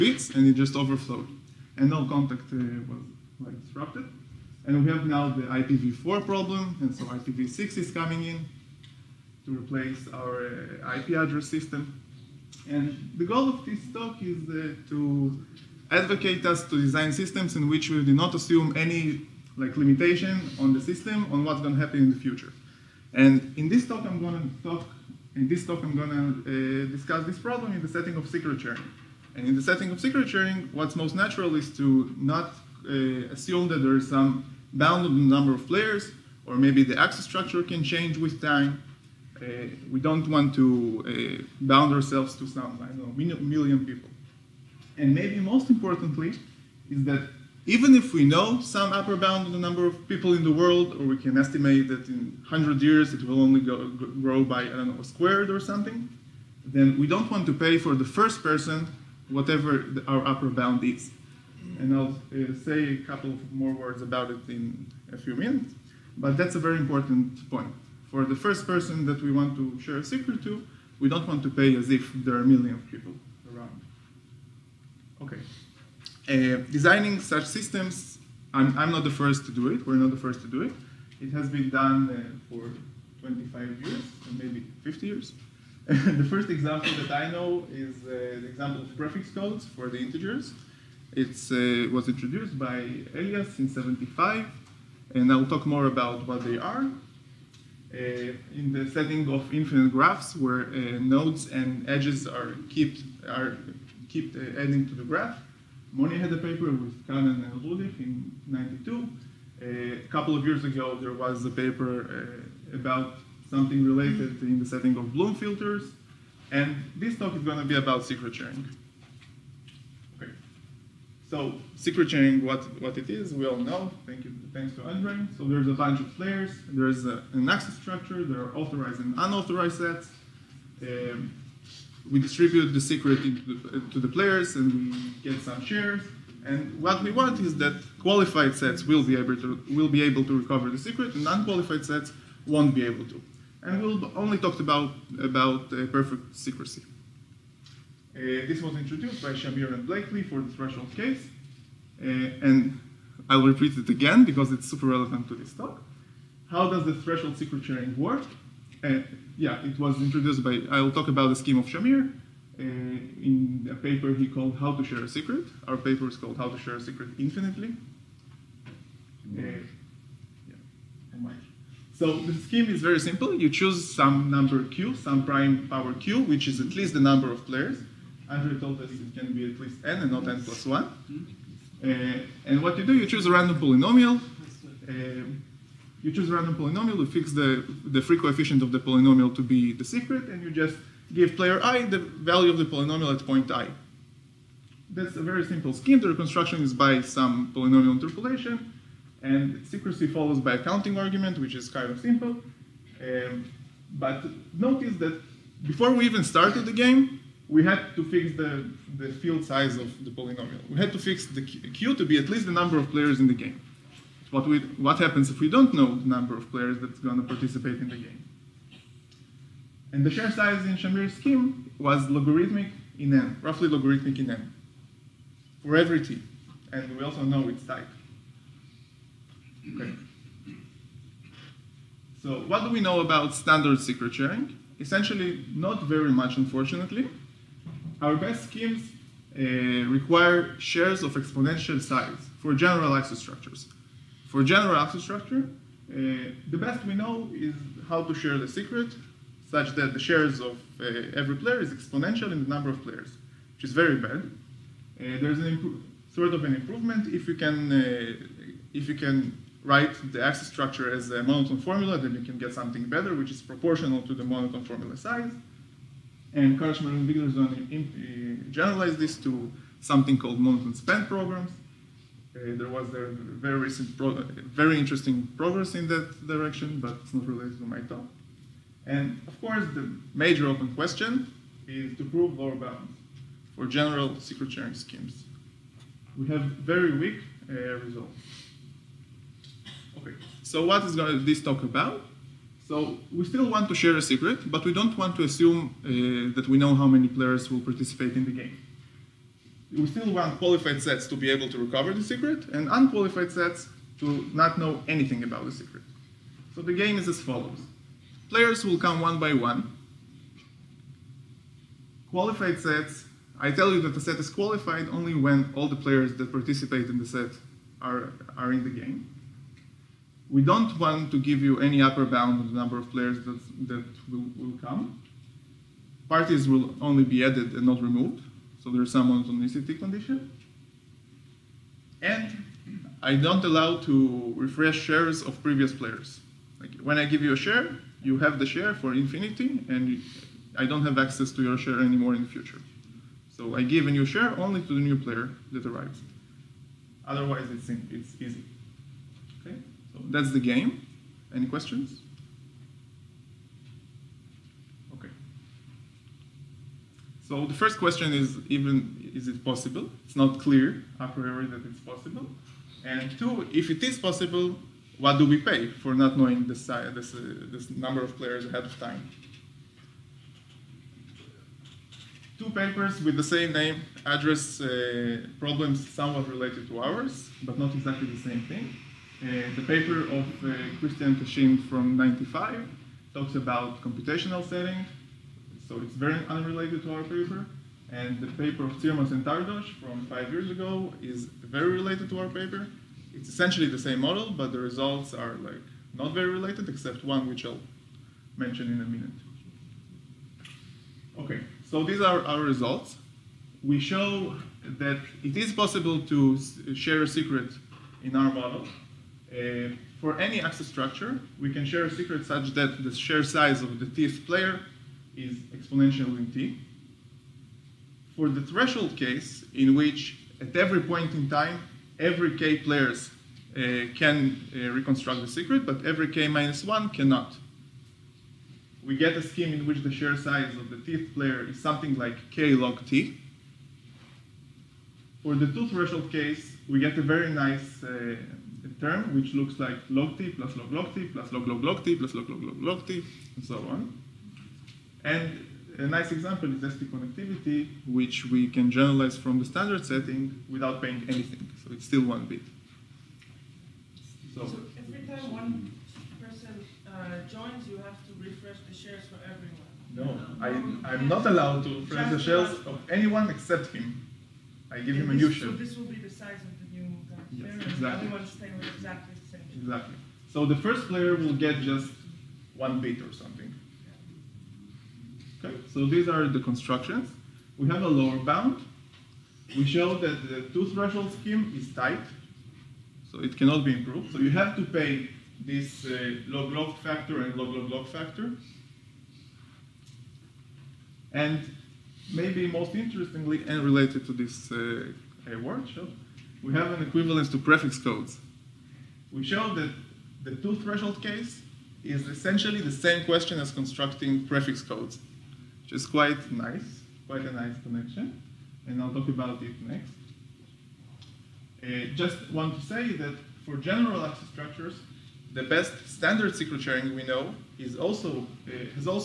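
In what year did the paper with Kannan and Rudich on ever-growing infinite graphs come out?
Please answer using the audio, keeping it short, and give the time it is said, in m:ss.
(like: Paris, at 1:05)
1992, at 1:48.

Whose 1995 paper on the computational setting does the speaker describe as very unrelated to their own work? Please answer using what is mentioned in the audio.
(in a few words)
Christian Cachin.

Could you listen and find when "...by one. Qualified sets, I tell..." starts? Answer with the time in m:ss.
5:09.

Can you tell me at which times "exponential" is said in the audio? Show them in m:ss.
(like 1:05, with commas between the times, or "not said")
4:01, 4:11, 6:55.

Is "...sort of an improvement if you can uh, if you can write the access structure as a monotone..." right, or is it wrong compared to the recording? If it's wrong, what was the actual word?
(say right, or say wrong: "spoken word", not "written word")
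right.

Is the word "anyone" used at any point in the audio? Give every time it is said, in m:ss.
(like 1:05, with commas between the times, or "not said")
7:42.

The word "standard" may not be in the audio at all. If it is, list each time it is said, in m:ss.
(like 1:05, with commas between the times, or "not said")
3:53, 7:29, 8:35.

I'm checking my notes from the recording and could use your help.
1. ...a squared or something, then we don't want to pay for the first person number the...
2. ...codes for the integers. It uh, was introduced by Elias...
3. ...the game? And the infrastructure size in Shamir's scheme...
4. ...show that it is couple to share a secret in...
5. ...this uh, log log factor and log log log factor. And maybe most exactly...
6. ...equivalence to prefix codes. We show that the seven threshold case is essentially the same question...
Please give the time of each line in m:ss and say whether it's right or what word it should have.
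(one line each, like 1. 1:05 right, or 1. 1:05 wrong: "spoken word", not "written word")
1. 0:55 wrong: "whatever", not "number"
2. 1:29 right
3. 3:37 wrong: "share", not "infrastructure"
4. 6:43 wrong: "possible", not "couple"
5. 8:05 wrong: "interestingly", not "exactly"
6. 8:16 wrong: "two", not "seven".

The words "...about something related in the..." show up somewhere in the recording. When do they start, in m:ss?
1:52.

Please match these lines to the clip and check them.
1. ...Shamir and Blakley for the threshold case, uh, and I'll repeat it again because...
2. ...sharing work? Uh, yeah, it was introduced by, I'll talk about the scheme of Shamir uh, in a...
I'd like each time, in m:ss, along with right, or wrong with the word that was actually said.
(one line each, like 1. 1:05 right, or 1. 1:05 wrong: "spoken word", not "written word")
1. 2:29 right
2. 2:37 right.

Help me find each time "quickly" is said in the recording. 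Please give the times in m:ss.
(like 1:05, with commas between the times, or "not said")
not said.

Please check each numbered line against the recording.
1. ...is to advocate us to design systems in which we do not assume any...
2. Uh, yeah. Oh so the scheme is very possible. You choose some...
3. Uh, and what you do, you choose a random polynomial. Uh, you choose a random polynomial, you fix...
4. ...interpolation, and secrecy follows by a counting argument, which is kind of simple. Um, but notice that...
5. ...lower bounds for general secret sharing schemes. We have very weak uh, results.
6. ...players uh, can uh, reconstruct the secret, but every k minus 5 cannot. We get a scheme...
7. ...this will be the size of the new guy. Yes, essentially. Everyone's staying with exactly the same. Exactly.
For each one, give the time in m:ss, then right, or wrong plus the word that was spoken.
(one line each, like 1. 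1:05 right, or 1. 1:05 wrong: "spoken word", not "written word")
1. 0:14 right
2. 2:48 wrong: "simple", not "possible"
3. 3:01 right
4. 3:17 right
5. 4:42 right
6. 7:02 wrong: "1", not "5"
7. 7:45 wrong: "exactly", not "essentially".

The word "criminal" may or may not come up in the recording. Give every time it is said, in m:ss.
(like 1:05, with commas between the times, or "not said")
not said.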